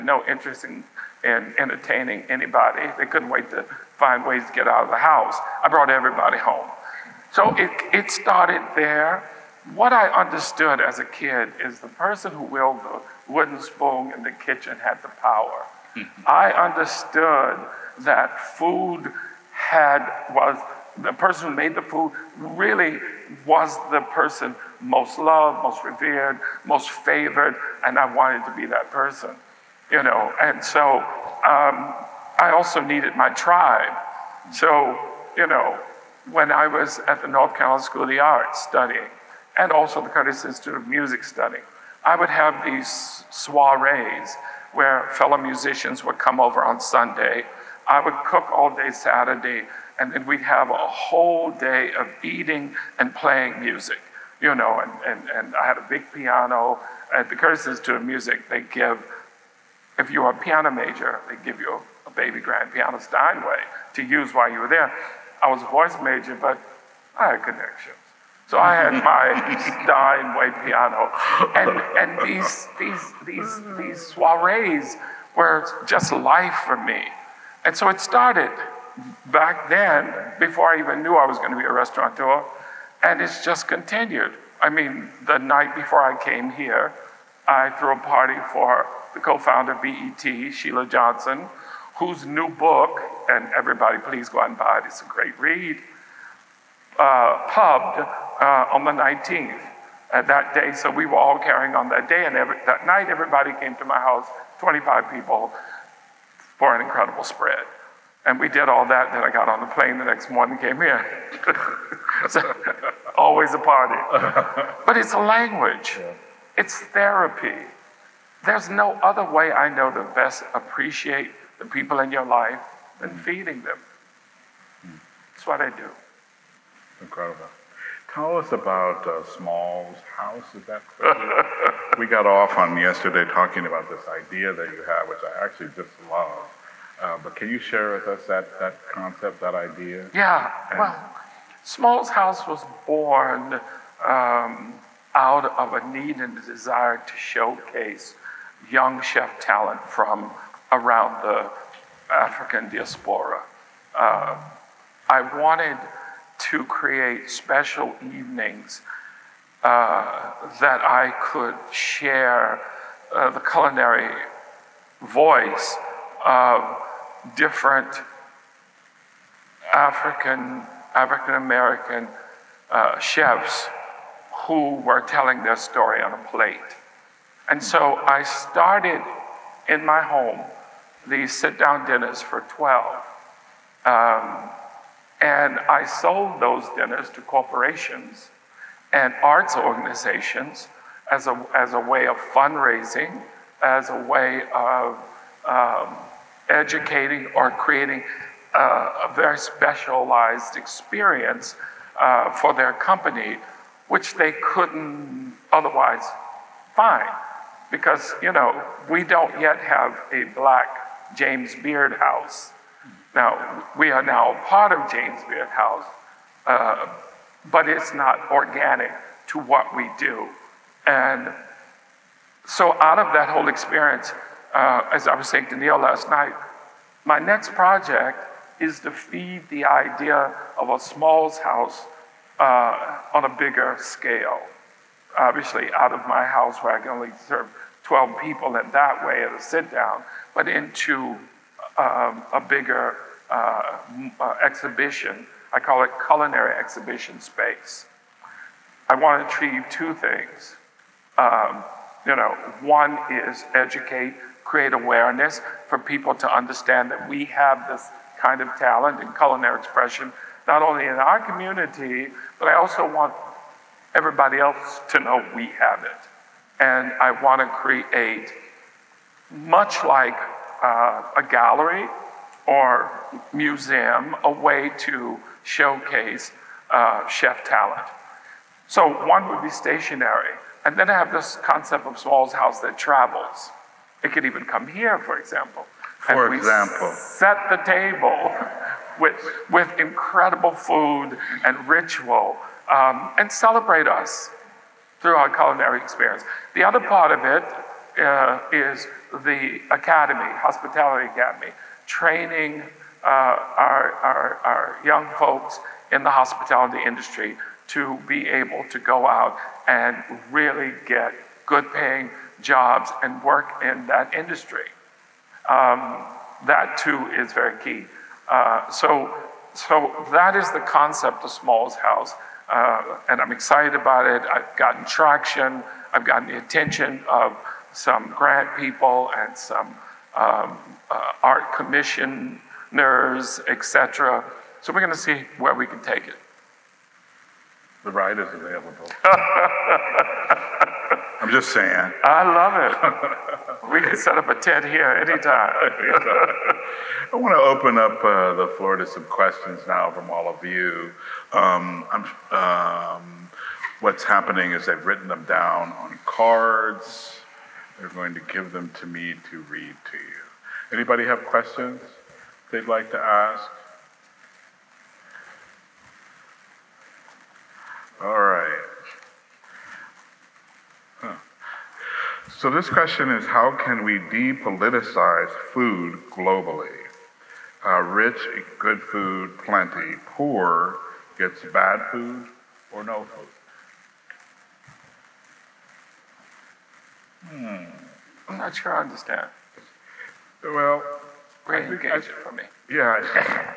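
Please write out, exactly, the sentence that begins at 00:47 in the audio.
I would cook all day Saturday, and then we'd have a whole day of eating and playing music, you know.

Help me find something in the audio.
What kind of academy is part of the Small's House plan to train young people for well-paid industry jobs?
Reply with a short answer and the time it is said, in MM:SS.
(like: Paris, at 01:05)
hospitality academy, at 05:00.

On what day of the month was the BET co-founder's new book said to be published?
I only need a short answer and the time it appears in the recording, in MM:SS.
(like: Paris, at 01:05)
19th, at 01:38.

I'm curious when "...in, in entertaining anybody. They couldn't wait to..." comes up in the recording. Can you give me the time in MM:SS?
00:00.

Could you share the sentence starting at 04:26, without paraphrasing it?
And I want to create, much like uh, a gallery or museum a way to showcase uh, chef talent.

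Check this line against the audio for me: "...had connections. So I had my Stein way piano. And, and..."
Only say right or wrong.
right.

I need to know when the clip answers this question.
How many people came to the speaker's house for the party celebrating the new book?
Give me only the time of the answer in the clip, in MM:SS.
01:44.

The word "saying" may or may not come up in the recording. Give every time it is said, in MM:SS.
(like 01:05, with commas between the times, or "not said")
03:45, 05:41.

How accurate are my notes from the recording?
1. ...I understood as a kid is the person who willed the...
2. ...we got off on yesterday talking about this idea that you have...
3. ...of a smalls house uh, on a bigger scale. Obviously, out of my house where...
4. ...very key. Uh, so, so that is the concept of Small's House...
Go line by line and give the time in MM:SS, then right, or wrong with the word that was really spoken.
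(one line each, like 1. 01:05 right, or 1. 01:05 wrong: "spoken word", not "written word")
1. 00:09 right
2. 02:11 right
3. 03:50 right
4. 05:17 right.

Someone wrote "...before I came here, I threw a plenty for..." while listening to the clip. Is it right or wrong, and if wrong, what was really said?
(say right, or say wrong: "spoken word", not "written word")
wrong: "party", not "plenty".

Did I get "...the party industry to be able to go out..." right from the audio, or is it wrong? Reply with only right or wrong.
wrong.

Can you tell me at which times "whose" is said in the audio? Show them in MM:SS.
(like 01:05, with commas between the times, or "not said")
01:31.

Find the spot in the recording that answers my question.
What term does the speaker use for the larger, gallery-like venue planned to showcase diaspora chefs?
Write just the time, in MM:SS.
04:06.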